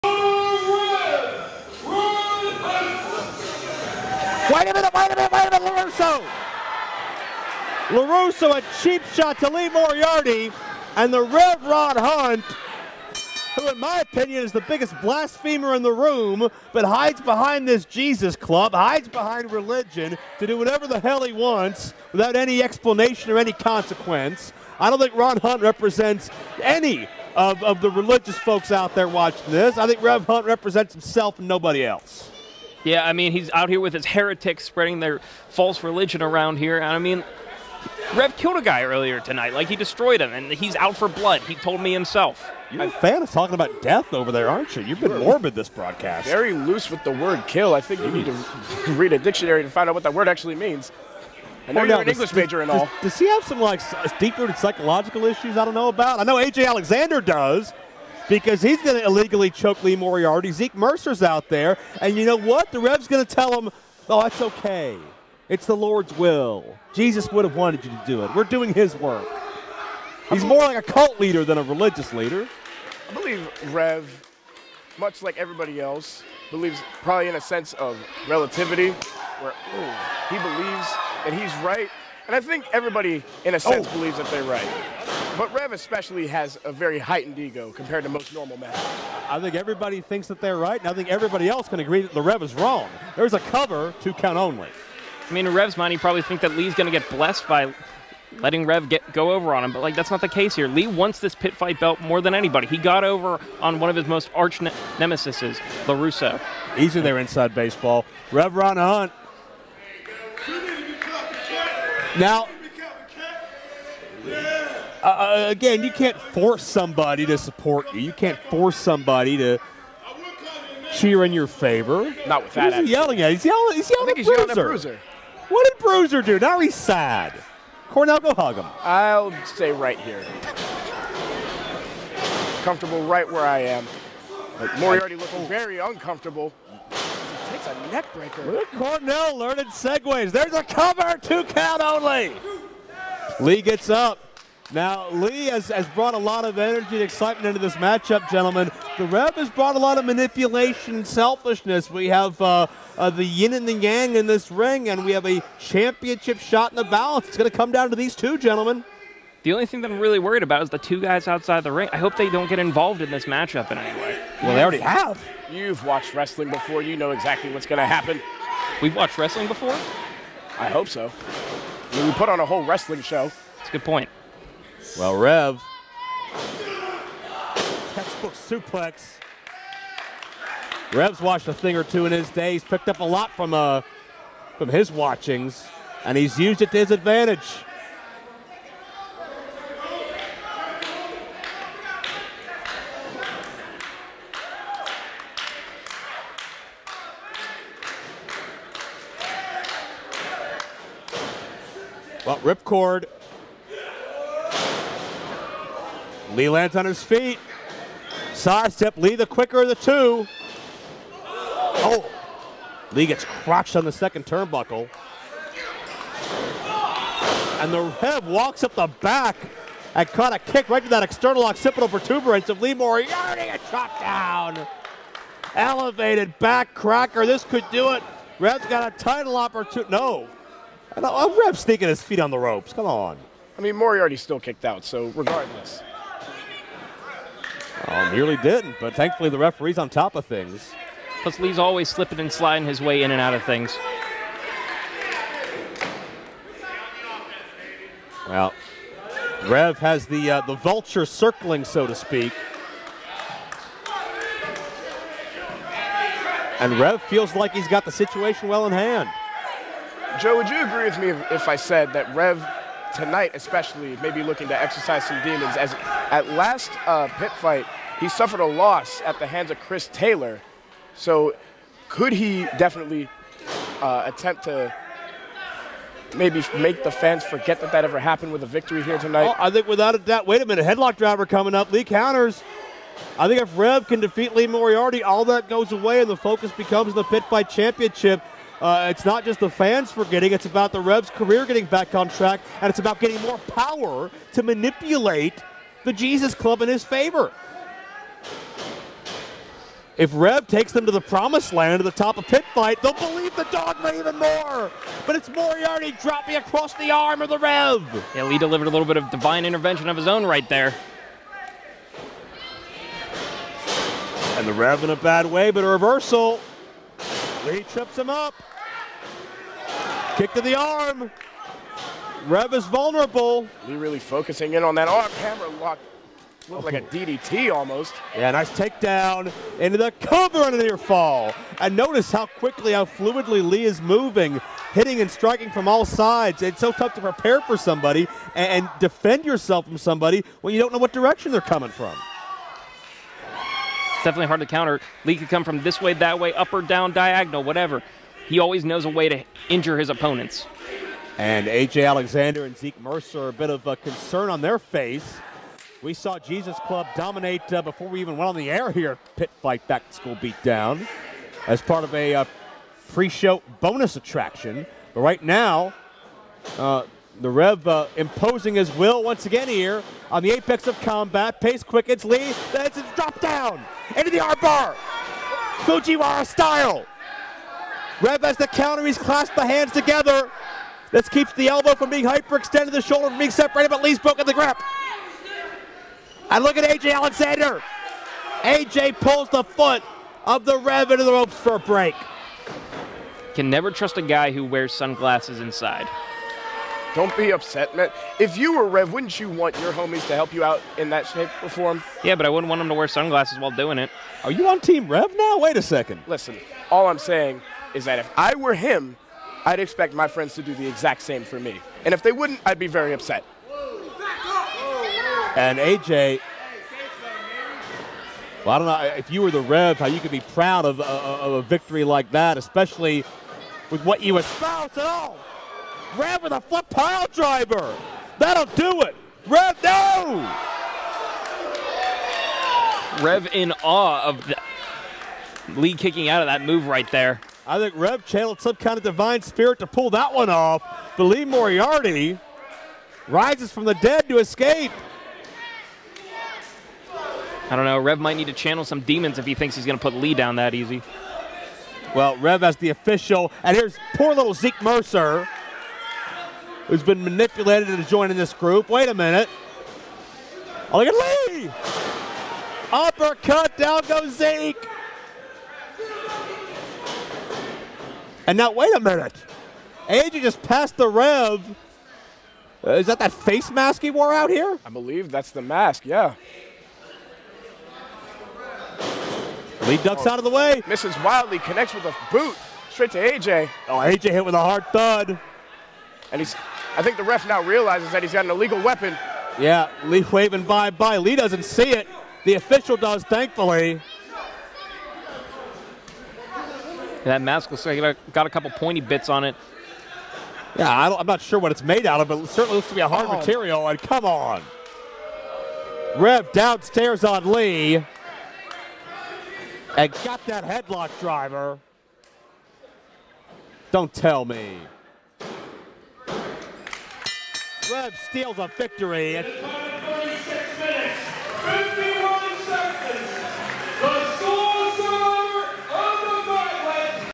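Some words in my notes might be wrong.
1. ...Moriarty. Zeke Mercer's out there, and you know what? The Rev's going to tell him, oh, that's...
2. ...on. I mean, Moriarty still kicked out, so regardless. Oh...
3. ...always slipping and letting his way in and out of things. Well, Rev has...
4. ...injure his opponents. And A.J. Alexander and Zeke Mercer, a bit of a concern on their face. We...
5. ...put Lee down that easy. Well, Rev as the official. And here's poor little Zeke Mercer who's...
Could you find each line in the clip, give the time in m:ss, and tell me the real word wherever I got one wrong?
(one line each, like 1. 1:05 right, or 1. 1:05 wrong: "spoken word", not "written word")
1. 0:59 right
2. 3:52 right
3. 4:01 wrong: "sliding", not "letting"
4. 5:49 right
5. 7:29 right.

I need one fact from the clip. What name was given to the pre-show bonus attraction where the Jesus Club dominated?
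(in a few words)
back to school beatdown.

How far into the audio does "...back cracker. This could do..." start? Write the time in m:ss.
3:46.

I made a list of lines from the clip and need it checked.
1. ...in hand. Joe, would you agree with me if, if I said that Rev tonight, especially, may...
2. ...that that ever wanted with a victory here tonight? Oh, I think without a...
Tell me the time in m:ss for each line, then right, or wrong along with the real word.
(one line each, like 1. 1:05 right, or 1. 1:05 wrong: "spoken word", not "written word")
1. 4:18 right
2. 4:37 wrong: "happened", not "wanted".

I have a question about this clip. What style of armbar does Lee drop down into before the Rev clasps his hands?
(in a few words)
Fujiwara.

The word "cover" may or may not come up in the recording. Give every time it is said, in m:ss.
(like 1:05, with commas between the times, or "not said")
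1:33, 2:20, 5:30.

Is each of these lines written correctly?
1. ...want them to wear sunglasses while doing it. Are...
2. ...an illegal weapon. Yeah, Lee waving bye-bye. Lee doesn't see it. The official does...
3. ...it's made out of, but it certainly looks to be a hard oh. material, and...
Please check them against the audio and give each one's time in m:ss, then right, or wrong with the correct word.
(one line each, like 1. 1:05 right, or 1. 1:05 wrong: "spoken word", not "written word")
1. 6:42 right
2. 8:08 right
3. 8:21 right.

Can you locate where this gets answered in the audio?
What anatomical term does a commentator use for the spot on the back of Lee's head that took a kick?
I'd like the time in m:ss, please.
3:41.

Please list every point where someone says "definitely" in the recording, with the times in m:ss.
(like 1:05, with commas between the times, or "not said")
4:32, 5:44.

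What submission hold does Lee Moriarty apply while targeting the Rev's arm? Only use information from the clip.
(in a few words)
Kimura lock.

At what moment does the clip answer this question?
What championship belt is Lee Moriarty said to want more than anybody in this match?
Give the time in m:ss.
1:41.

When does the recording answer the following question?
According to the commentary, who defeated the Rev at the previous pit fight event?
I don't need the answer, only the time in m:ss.
4:29.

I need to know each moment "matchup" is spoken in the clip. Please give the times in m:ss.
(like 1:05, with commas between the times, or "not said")
2:27, 2:43.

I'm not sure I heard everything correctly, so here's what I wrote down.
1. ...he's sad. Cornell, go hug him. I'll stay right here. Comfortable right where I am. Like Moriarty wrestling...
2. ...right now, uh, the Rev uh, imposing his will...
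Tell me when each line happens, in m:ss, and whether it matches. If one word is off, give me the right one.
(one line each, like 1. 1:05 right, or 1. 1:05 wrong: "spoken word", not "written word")
1. 2:06 wrong: "looking", not "wrestling"
2. 6:05 right.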